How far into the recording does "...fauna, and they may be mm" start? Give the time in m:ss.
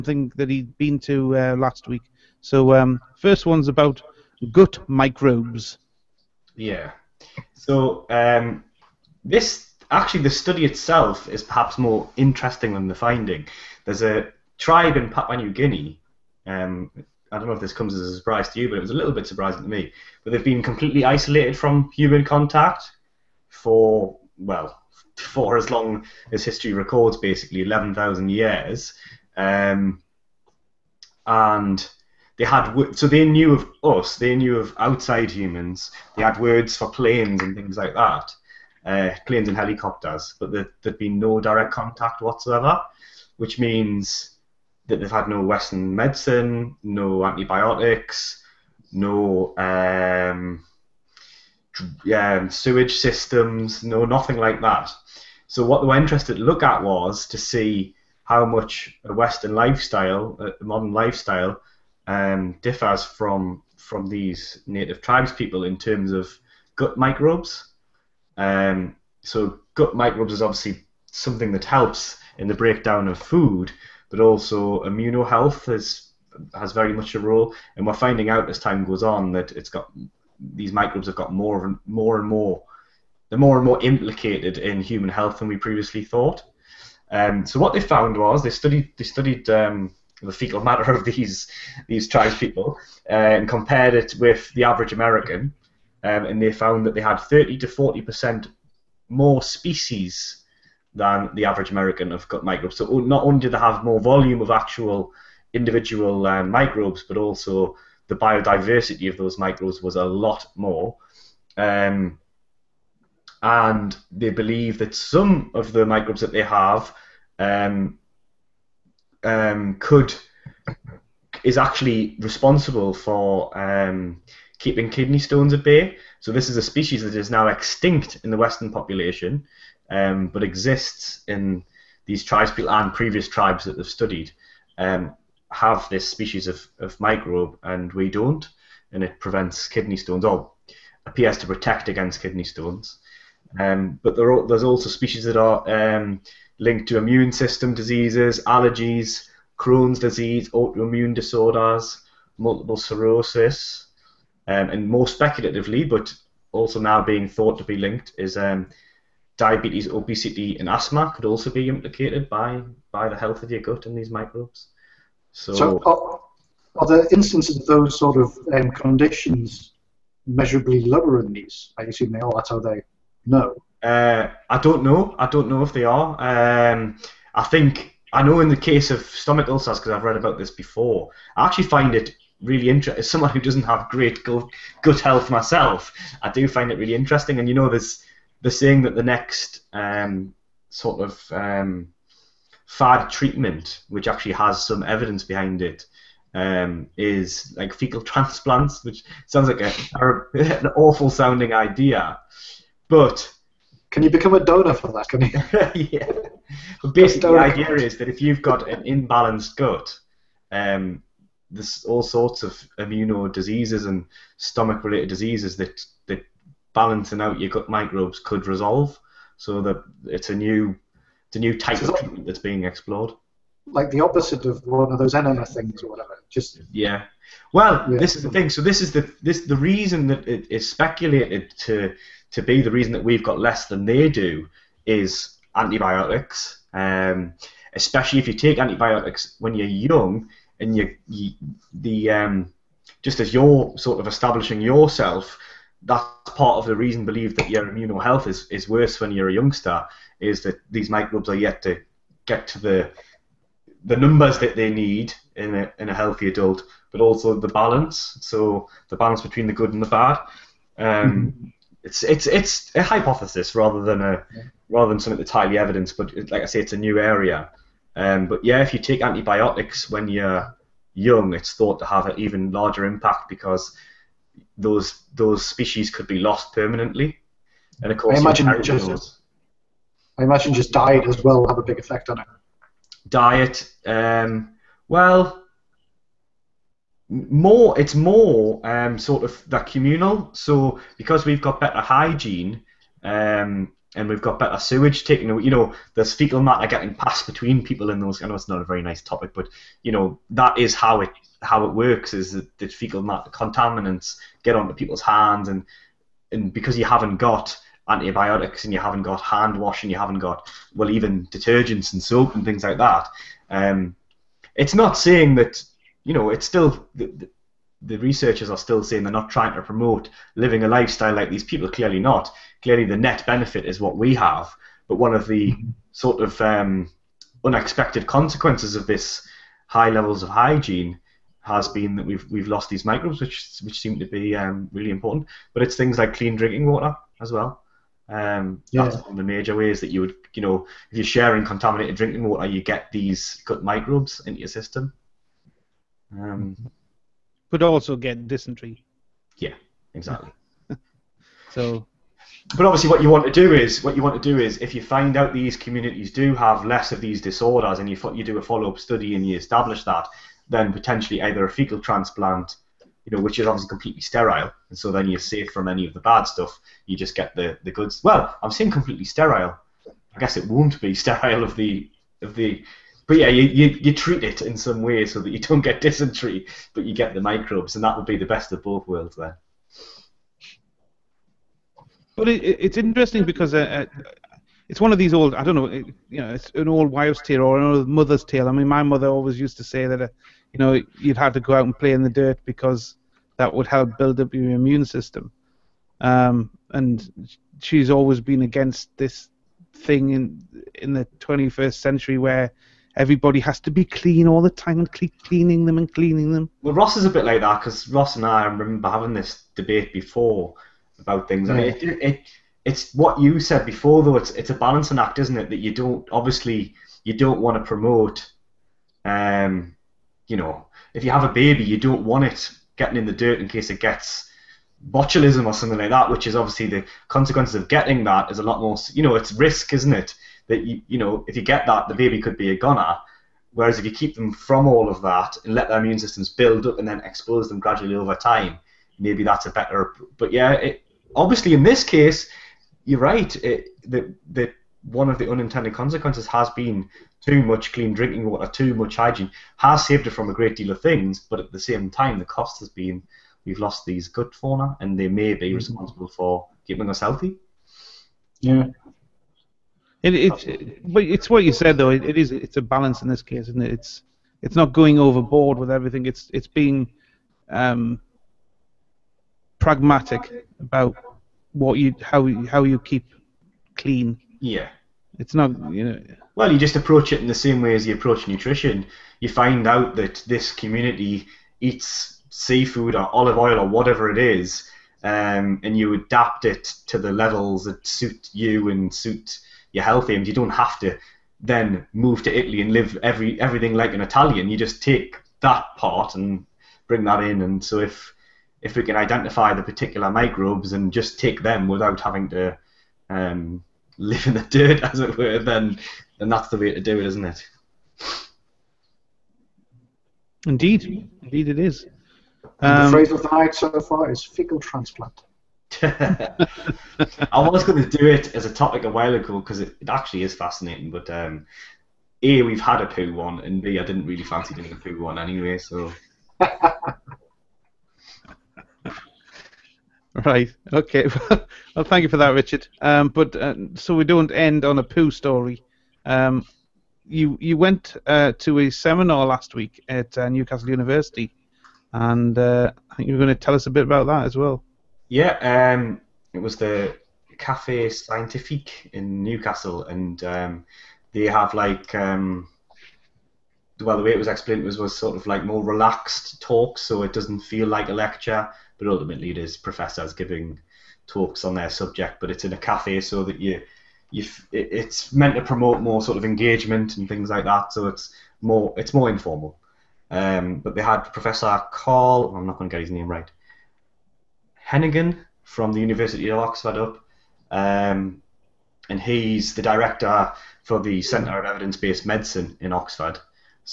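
7:34.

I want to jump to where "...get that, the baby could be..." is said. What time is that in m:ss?
7:11.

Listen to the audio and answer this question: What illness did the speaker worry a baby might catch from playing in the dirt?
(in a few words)
Botulism.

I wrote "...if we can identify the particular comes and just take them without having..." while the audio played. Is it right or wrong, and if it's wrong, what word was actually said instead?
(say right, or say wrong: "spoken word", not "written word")
wrong: "microbes", not "comes".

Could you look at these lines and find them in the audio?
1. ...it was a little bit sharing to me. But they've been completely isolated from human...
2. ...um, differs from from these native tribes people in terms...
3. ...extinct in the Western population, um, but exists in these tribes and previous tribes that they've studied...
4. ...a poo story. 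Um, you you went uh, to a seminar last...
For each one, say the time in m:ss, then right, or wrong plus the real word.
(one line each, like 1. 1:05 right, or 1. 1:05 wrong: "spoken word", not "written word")
1. 0:18 wrong: "surprising", not "sharing"
2. 1:02 right
3. 2:07 right
4. 8:54 right.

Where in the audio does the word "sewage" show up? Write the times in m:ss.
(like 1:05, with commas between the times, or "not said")
0:52, 4:54.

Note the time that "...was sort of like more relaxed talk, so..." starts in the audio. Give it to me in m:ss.
9:14.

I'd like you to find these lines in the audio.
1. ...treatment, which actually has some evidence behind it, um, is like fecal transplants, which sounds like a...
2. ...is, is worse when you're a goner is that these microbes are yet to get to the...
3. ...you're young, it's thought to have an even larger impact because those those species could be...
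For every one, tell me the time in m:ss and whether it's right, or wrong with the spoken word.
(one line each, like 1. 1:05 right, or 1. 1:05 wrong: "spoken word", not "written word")
1. 3:13 right
2. 4:08 wrong: "youngster", not "goner"
3. 4:30 right.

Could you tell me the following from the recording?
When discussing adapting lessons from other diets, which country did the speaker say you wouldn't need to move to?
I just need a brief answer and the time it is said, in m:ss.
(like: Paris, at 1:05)
Italy, at 8:12.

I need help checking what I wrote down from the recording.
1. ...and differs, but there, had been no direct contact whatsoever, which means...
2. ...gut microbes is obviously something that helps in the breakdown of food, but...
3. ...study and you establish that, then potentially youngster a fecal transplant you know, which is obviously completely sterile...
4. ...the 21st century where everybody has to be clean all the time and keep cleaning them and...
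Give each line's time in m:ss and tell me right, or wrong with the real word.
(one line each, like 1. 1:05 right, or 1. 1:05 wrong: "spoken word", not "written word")
1. 0:39 wrong: "helicopters", not "differs"
2. 1:09 right
3. 5:58 wrong: "either", not "youngster"
4. 6:40 right.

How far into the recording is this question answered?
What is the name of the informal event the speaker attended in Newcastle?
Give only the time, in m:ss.
9:07.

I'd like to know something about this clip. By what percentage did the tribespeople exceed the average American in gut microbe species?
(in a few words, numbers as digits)
30 to 40 percent.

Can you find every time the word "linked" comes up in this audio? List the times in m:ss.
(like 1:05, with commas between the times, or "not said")
2:26, 2:37.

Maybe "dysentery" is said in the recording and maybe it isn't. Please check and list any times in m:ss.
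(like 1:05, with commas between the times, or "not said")
5:48, 6:15.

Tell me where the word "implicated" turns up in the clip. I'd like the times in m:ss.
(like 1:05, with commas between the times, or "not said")
1:23, 2:41.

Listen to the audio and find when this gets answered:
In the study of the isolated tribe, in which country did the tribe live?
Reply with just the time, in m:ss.
0:15.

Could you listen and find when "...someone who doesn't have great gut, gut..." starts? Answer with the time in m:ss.
3:03.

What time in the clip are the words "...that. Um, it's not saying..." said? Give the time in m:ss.
5:12.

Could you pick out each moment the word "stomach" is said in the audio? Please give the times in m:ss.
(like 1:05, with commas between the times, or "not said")
2:59, 3:34.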